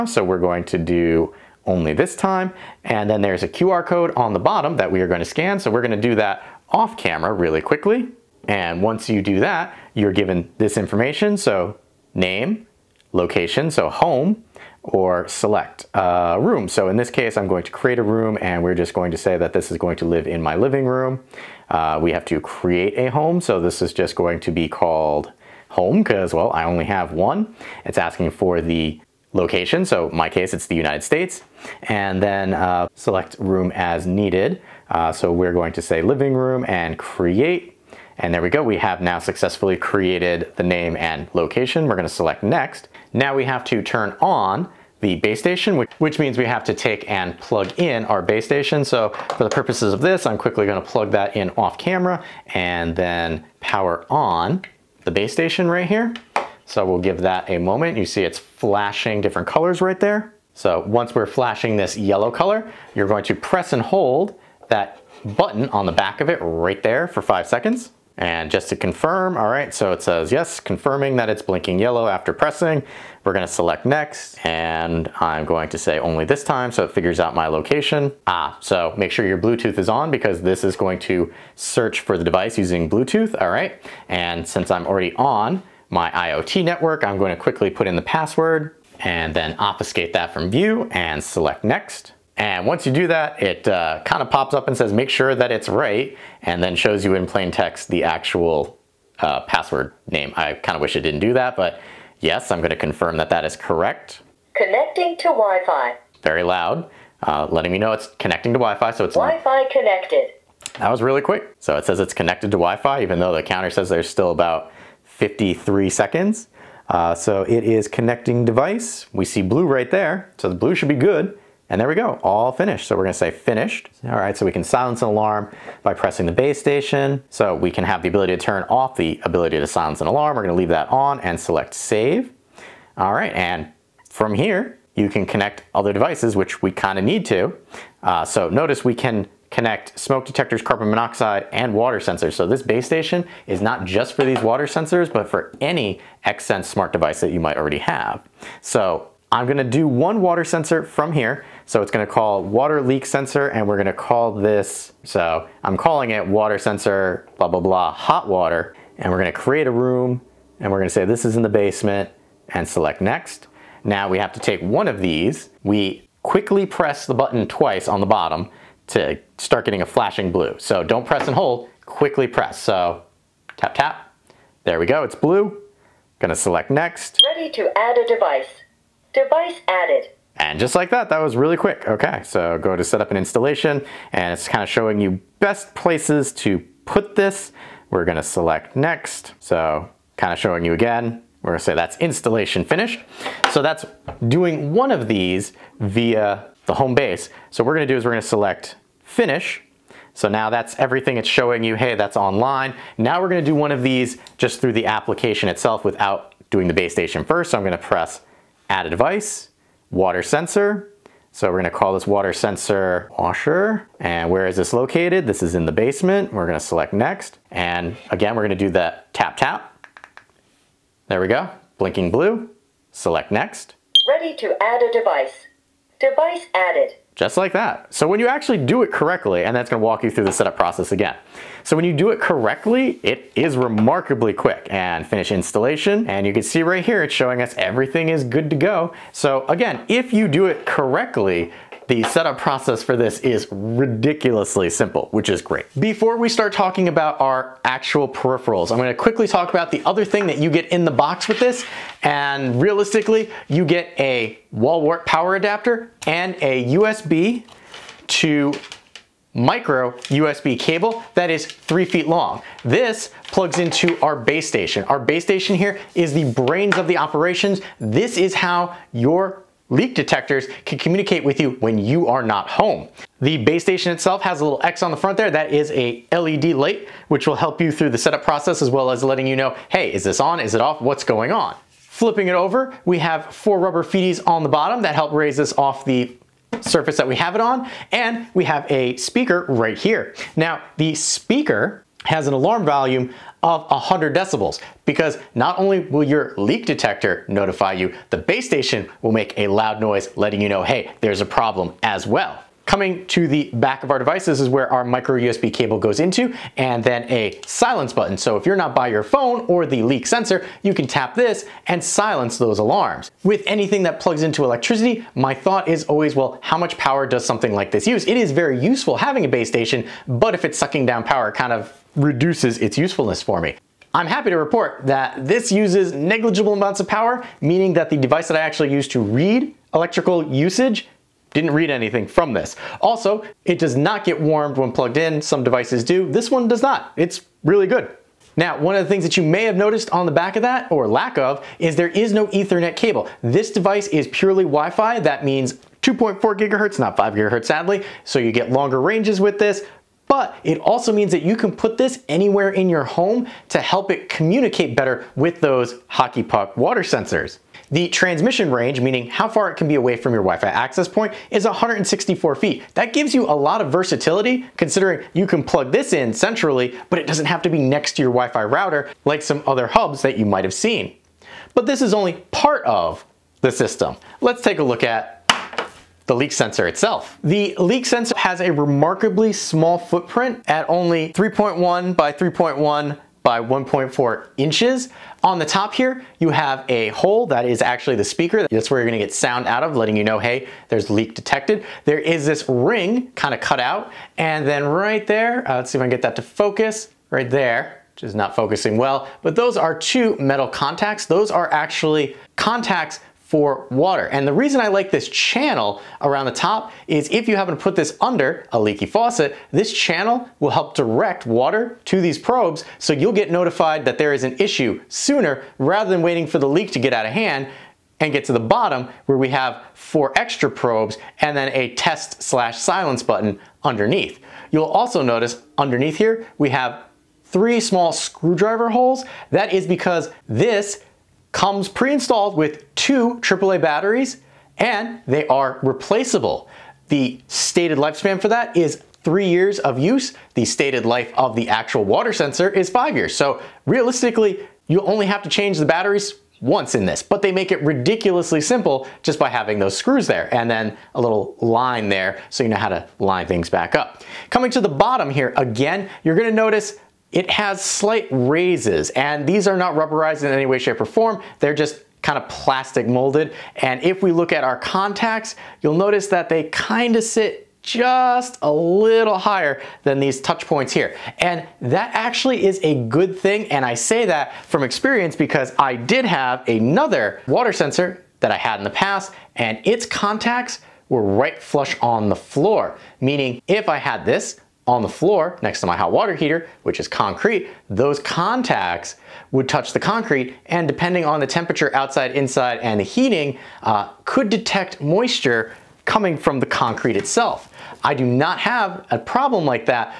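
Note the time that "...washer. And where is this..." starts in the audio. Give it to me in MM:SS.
03:33.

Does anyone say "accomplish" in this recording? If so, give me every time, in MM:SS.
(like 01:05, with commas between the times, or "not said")
not said.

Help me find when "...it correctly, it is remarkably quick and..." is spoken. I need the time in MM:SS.
03:52.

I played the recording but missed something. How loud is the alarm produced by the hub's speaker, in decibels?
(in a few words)
100 decibels.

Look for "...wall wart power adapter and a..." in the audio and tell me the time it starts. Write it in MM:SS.
04:14.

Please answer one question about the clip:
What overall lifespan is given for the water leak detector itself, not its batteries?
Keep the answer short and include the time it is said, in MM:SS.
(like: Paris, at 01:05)
5 years, at 07:22.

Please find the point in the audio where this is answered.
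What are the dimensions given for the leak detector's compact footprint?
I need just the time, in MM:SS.
06:21.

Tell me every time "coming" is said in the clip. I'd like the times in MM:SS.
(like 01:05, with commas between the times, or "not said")
05:02, 07:34, 08:15.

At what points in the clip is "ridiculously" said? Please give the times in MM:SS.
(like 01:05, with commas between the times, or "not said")
04:03, 07:27.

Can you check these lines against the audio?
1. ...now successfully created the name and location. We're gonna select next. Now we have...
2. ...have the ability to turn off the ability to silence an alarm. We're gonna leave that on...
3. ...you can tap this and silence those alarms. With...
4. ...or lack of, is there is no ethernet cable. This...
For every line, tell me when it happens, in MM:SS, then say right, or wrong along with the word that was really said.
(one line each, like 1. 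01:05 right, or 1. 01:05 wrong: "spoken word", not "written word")
1. 00:39 right
2. 02:07 right
3. 05:10 right
4. 05:40 right.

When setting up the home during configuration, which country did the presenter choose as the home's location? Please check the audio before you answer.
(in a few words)
United States.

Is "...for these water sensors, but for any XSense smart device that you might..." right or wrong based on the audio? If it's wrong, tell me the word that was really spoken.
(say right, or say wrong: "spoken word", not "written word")
right.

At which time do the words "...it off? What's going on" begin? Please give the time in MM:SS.
04:40.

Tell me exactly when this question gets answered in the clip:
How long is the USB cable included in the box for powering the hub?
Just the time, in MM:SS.
04:21.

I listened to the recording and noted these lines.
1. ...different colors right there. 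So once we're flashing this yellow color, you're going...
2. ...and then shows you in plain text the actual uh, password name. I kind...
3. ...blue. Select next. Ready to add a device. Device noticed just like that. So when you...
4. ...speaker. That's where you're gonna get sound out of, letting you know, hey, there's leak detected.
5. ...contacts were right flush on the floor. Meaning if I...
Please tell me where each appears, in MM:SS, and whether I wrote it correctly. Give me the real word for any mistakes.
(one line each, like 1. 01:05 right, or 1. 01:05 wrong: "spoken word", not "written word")
1. 00:59 right
2. 01:36 right
3. 03:42 wrong: "added", not "noticed"
4. 06:28 right
5. 07:59 right.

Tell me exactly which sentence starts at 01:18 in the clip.
Ah, so make sure your Bluetooth is on because this is going to search for the device using Bluetooth, all right?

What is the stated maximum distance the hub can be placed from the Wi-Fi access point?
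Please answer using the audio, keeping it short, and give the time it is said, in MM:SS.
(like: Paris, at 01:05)
164 feet, at 06:01.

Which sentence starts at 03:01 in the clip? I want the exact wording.
Okay, so go to set up an installation and it's kind of showing you best places to put this.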